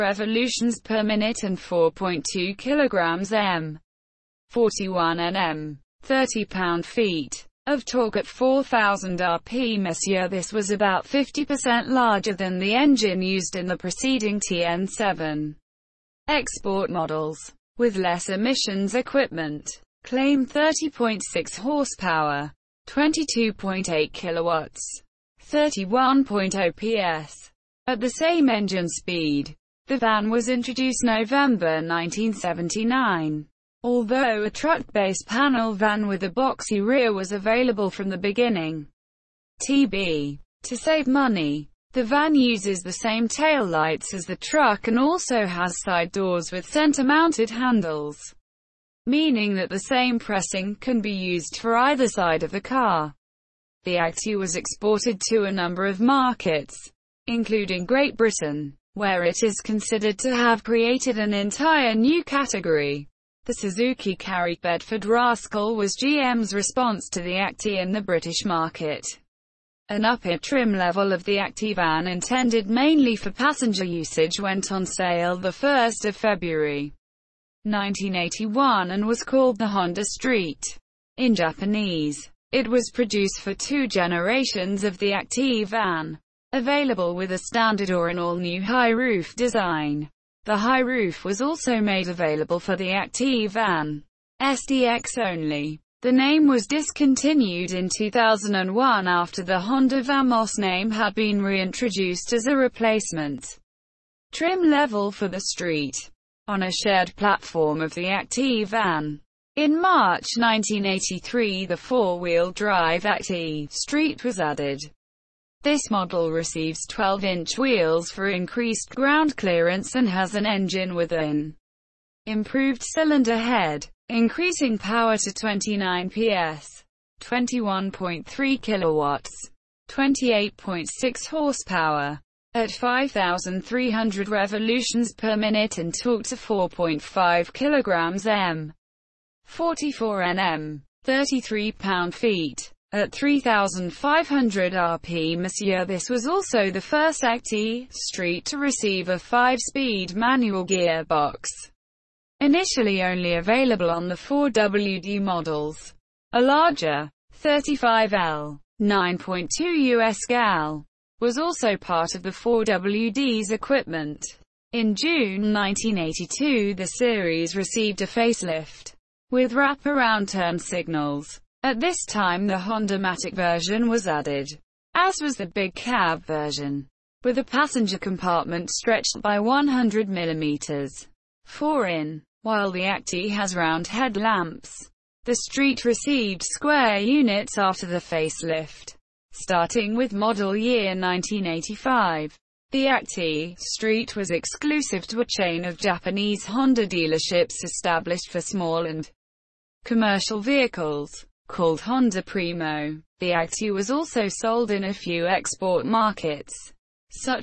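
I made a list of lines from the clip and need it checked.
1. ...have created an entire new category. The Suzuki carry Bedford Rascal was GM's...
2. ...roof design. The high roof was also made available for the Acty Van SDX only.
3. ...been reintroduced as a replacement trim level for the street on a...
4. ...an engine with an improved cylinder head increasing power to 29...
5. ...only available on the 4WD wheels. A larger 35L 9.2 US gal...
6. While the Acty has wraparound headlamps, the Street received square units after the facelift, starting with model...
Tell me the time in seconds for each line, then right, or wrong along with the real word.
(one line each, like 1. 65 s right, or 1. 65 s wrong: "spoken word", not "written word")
1. 60 s right
2. 88 s right
3. 101 s right
4. 120 s right
5. 153 s wrong: "models", not "wheels"
6. 182 s wrong: "round", not "wraparound".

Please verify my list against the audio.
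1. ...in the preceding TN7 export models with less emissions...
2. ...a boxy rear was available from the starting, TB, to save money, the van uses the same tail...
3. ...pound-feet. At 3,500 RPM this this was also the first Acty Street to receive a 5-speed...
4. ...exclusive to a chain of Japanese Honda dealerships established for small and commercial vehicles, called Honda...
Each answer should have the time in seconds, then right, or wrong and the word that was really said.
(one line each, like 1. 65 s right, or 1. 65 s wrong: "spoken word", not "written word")
1. 13 s right
2. 36 s wrong: "beginning", not "starting"
3. 141 s right
4. 194 s right.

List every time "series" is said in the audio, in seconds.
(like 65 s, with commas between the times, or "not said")
166 s.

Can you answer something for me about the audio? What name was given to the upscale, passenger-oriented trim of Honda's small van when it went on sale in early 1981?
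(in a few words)
Honda Street.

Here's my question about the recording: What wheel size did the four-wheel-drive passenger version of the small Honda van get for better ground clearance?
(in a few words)
12-inch.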